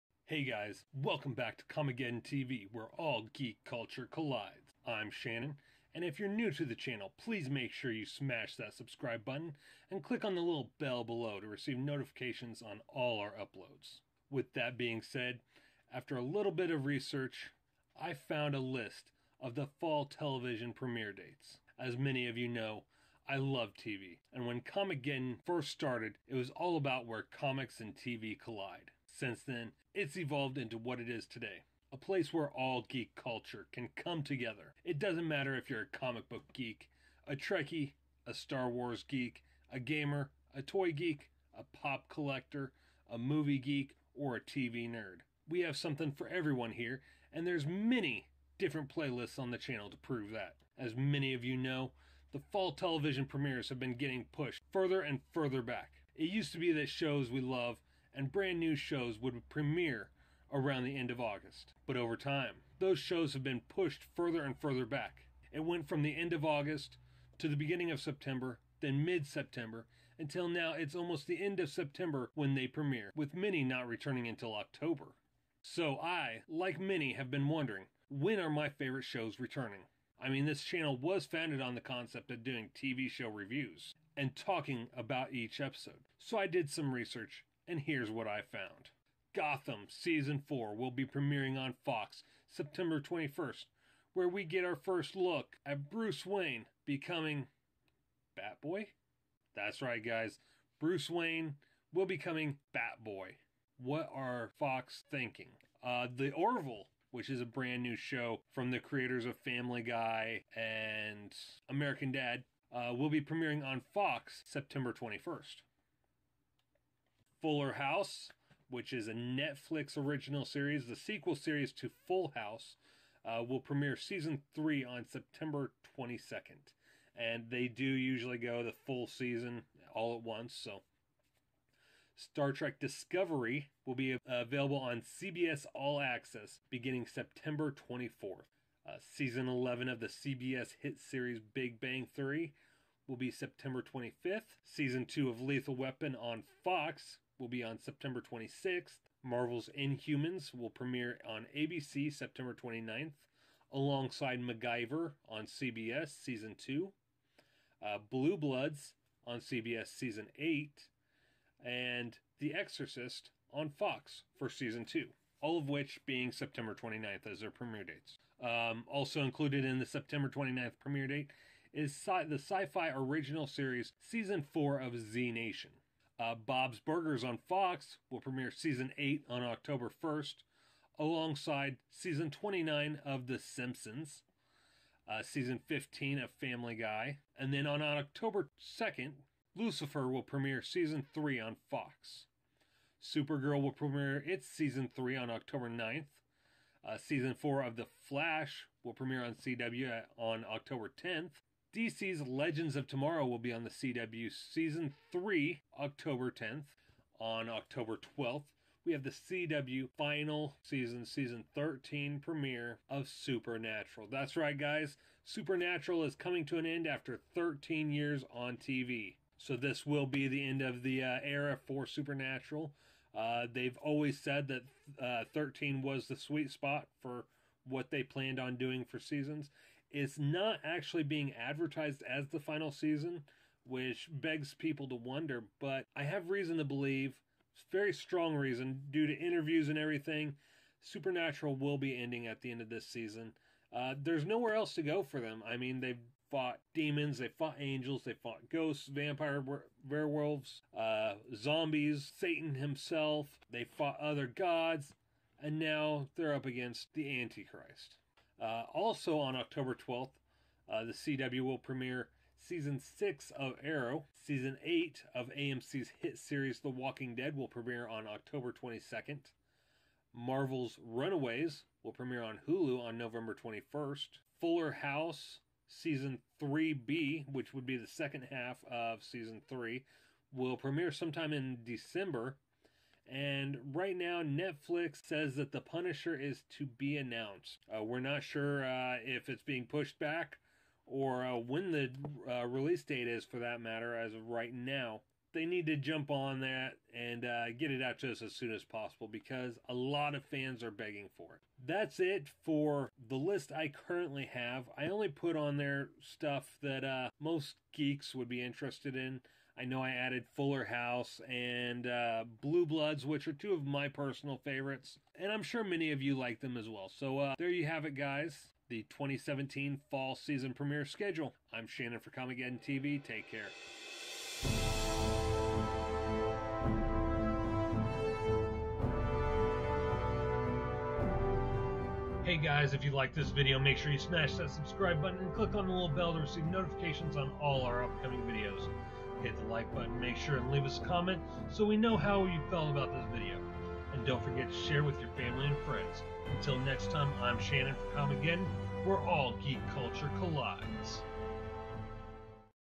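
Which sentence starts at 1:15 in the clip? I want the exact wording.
So I, like many, have been wondering when are my favorite shows returning?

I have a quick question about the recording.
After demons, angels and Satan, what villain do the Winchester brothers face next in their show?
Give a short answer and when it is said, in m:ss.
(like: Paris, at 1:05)
The Antichrist, at 4:16.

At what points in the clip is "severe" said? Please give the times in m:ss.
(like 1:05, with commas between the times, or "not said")
not said.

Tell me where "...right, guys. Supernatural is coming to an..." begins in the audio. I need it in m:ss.
3:34.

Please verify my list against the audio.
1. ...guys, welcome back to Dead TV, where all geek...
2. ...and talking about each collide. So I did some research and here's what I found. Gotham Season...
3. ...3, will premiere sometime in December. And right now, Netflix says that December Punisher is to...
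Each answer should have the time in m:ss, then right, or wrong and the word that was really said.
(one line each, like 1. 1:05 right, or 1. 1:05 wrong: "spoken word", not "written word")
1. 0:00 wrong: "Comicgeddon", not "Dead"
2. 1:24 wrong: "episode", not "collide"
3. 4:39 wrong: "The", not "December".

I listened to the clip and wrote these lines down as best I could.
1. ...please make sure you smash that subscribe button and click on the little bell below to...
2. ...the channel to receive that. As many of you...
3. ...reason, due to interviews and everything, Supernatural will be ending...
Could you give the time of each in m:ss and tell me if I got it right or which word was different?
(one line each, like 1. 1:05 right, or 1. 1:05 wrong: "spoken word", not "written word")
1. 0:07 right
2. 0:49 wrong: "prove", not "receive"
3. 3:58 right.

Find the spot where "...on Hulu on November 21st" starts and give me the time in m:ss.
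4:32.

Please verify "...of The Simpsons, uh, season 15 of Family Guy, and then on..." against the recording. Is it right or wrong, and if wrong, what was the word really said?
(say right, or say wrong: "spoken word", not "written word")
right.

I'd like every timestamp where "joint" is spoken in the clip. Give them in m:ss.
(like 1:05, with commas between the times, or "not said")
not said.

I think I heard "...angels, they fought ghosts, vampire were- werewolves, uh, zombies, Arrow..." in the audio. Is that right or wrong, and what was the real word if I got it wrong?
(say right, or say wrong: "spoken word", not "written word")
wrong: "Satan", not "Arrow".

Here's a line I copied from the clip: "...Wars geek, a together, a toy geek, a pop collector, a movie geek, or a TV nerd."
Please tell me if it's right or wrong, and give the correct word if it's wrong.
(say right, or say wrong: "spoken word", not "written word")
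wrong: "gamer", not "together".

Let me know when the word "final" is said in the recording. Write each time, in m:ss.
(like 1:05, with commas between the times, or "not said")
3:29, 3:52.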